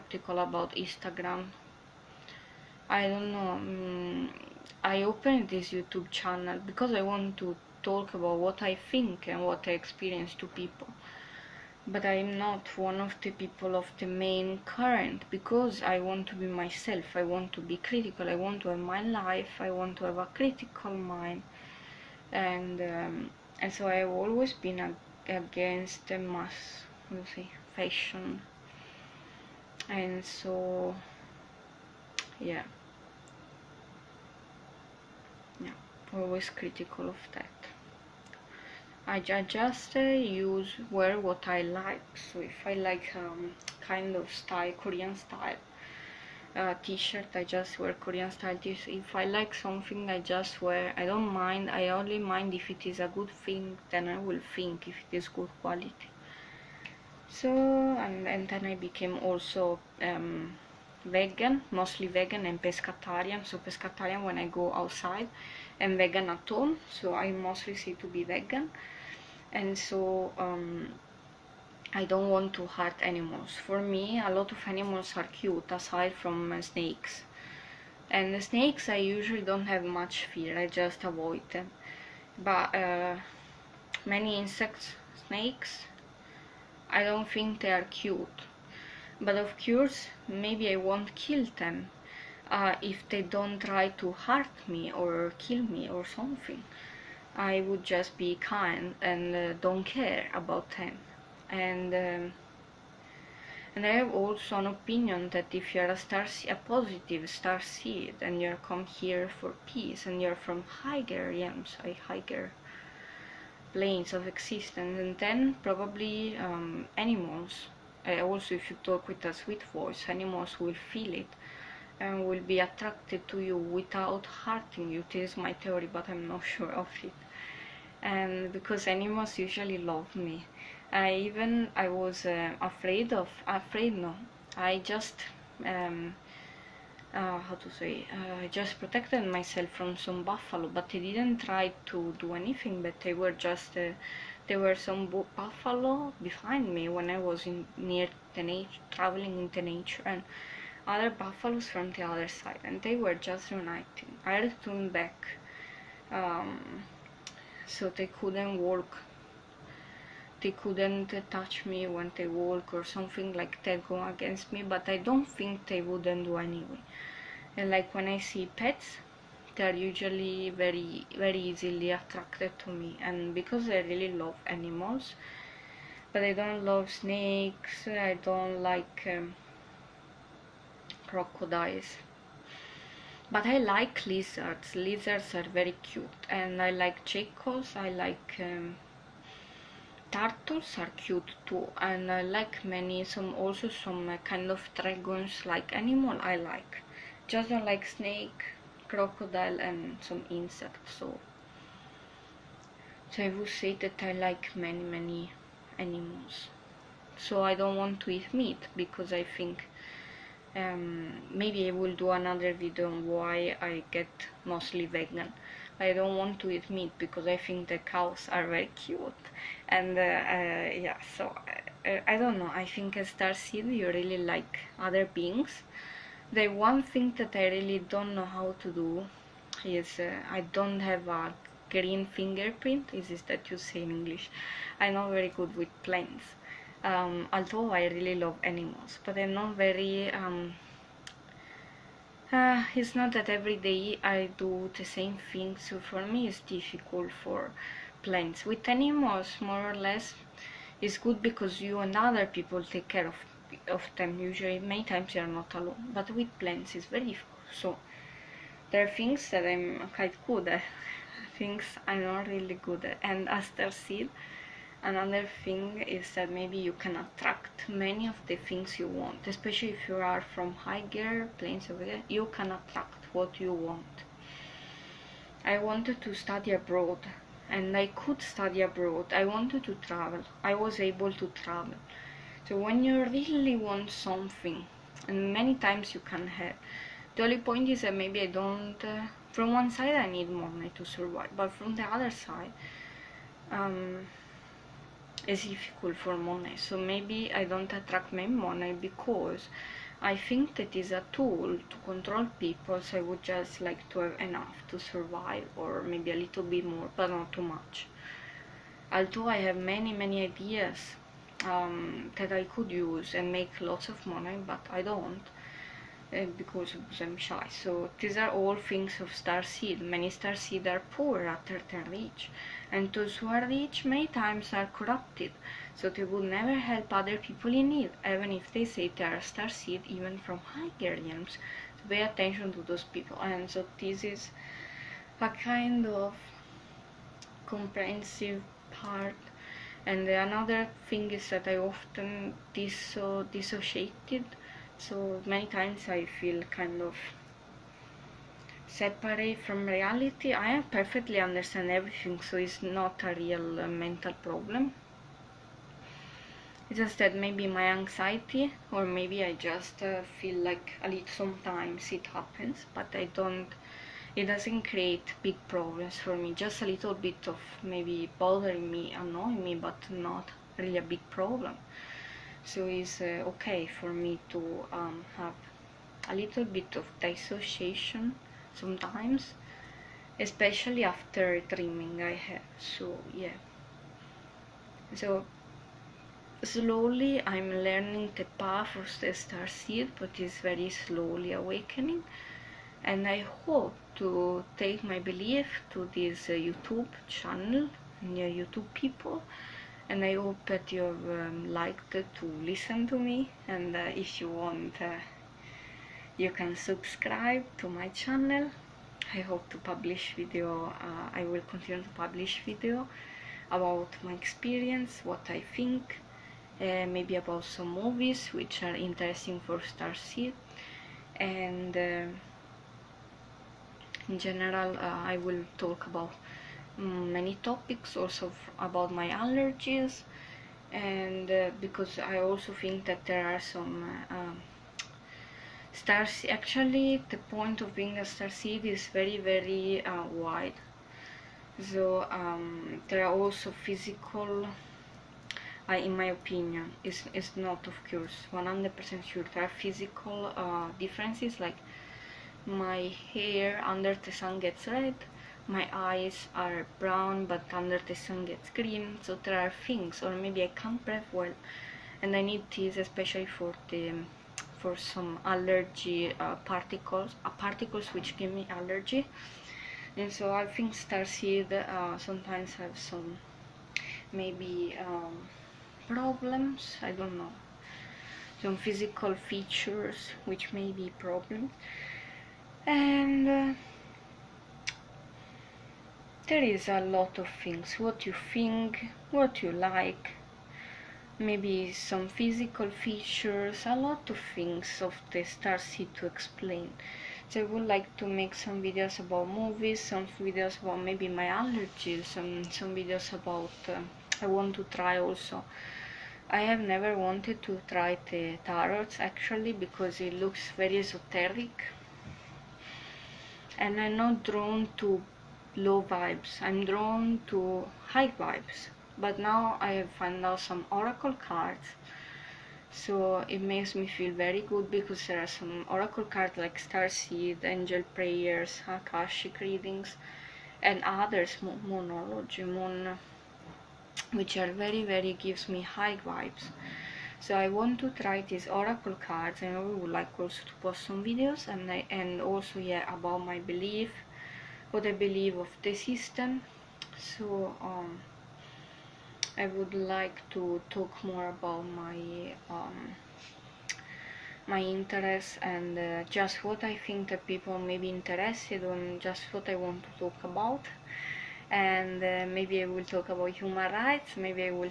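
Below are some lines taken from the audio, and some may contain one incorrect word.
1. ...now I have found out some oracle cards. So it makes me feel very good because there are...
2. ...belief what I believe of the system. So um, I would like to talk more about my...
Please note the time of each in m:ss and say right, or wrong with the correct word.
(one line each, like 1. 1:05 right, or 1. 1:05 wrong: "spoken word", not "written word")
1. 8:39 right
2. 9:03 right.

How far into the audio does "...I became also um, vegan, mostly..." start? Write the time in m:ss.
0:58.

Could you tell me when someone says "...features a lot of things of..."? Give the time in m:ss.
8:12.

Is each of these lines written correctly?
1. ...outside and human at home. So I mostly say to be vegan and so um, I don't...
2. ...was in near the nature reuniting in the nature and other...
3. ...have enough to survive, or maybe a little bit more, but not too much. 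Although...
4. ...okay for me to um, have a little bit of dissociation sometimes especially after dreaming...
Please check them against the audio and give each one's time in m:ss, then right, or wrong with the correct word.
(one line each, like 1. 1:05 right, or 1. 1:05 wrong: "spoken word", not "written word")
1. 1:04 wrong: "vegan", not "human"
2. 2:27 wrong: "traveling", not "reuniting"
3. 5:03 right
4. 6:13 right.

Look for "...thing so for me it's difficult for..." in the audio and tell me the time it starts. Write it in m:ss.
4:05.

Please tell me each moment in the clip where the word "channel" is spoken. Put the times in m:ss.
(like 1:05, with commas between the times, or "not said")
0:06, 6:37, 6:47.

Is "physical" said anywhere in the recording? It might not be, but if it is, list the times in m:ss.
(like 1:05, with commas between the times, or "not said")
7:23, 7:29, 7:58, 8:12.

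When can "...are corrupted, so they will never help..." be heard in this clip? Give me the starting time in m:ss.
5:24.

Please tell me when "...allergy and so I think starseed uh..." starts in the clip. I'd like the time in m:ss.
7:48.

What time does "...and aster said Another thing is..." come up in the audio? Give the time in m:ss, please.
4:23.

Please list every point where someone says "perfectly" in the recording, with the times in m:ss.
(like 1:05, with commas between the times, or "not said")
5:50.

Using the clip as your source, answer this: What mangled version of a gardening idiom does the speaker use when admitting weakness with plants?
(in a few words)
green fingerprint.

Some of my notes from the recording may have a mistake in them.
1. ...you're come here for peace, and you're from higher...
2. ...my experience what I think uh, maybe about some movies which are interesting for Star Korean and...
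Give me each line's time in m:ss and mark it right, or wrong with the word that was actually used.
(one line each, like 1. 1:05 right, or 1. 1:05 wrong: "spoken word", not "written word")
1. 1:48 right
2. 6:54 wrong: "Seed", not "Korean".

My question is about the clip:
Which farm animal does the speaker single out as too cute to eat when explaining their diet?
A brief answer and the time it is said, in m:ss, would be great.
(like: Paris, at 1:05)
cows, at 3:37.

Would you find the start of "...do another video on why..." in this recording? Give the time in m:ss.
3:31.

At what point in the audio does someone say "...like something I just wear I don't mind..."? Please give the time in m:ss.
0:49.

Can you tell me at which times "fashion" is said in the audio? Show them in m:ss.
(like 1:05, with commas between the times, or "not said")
0:27.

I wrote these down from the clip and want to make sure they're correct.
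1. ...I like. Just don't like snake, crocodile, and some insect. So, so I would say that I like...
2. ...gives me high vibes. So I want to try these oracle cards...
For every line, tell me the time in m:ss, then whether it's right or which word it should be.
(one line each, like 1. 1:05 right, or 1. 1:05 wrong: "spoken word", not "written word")
1. 3:16 right
2. 8:55 right.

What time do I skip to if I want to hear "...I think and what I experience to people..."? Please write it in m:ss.
0:08.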